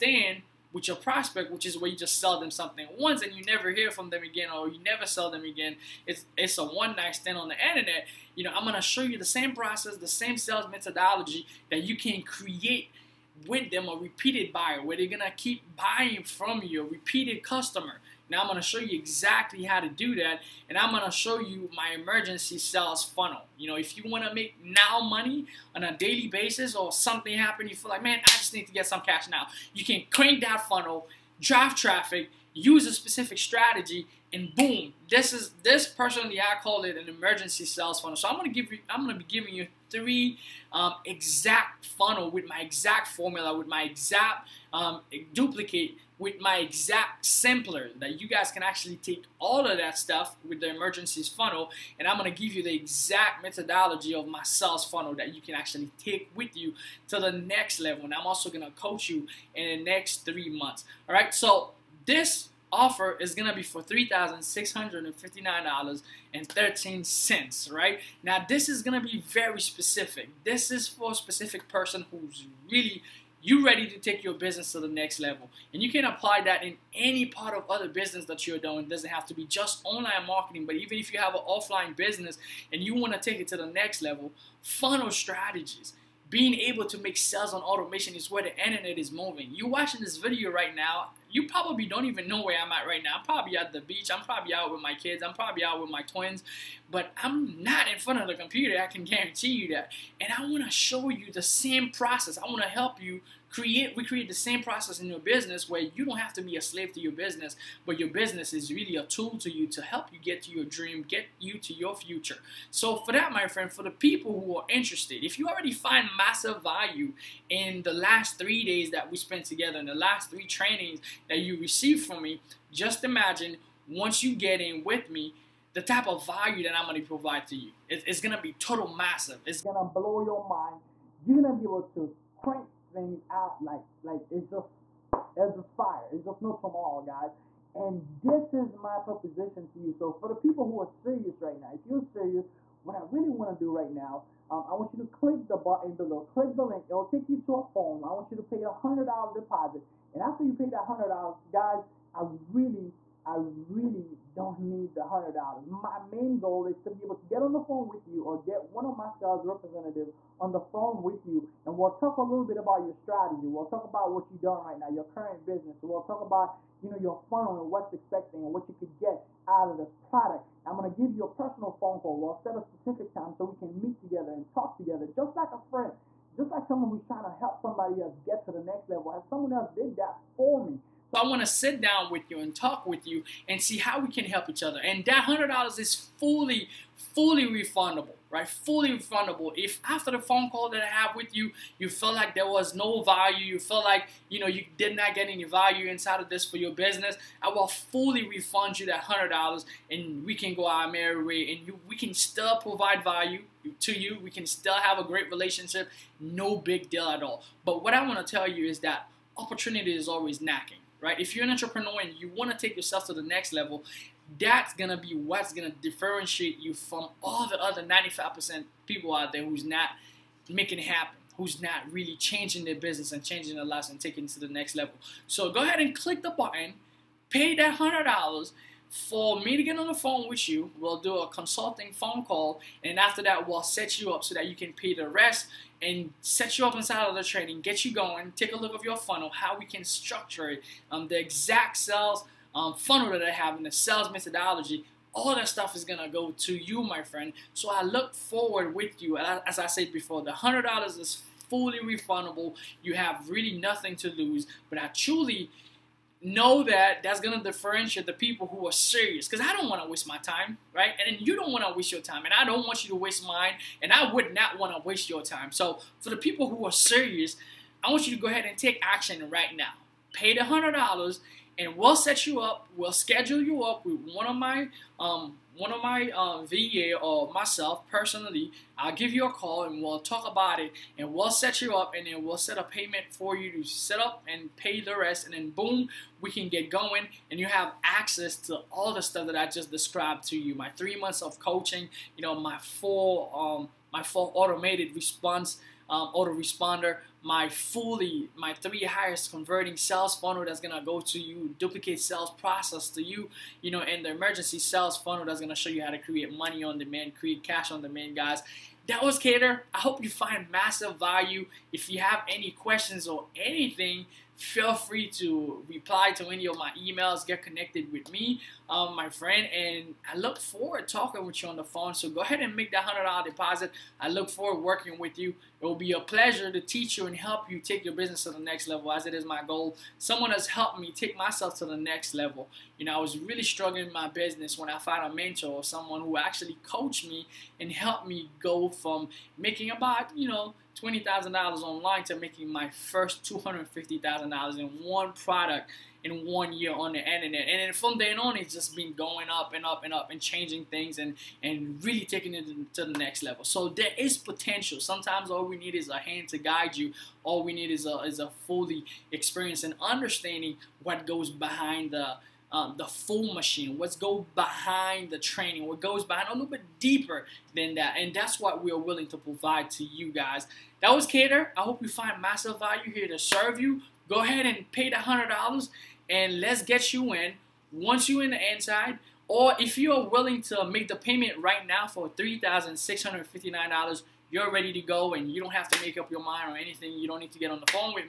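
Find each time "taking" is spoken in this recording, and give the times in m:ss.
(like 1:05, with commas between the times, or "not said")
3:43, 5:52.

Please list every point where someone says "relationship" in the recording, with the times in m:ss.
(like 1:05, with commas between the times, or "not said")
3:25.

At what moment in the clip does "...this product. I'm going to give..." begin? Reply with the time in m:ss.
2:49.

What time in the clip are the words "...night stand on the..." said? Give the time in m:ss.
0:06.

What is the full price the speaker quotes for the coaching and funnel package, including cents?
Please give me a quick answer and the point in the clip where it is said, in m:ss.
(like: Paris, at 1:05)
$3,659.13, at 1:03.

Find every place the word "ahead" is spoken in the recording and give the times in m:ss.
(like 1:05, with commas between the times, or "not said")
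3:45, 4:28, 5:22, 6:14.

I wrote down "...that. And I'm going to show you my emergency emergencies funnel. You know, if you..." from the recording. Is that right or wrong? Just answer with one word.
wrong.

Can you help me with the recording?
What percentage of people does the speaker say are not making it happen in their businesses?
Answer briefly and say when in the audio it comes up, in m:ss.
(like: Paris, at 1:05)
95%, at 3:37.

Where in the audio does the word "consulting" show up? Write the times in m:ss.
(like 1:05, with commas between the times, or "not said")
3:51.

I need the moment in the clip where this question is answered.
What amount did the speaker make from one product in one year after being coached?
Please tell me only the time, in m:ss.
5:43.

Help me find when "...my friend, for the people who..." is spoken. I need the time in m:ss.
1:53.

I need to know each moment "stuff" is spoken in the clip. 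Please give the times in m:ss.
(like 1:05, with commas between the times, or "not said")
0:49, 4:05, 4:49.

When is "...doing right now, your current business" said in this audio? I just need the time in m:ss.
2:44.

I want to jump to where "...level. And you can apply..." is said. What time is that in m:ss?
1:15.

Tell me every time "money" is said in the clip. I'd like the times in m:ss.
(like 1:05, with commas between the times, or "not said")
0:24, 5:06.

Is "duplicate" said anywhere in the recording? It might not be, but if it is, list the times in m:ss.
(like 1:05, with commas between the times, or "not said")
0:45, 5:01.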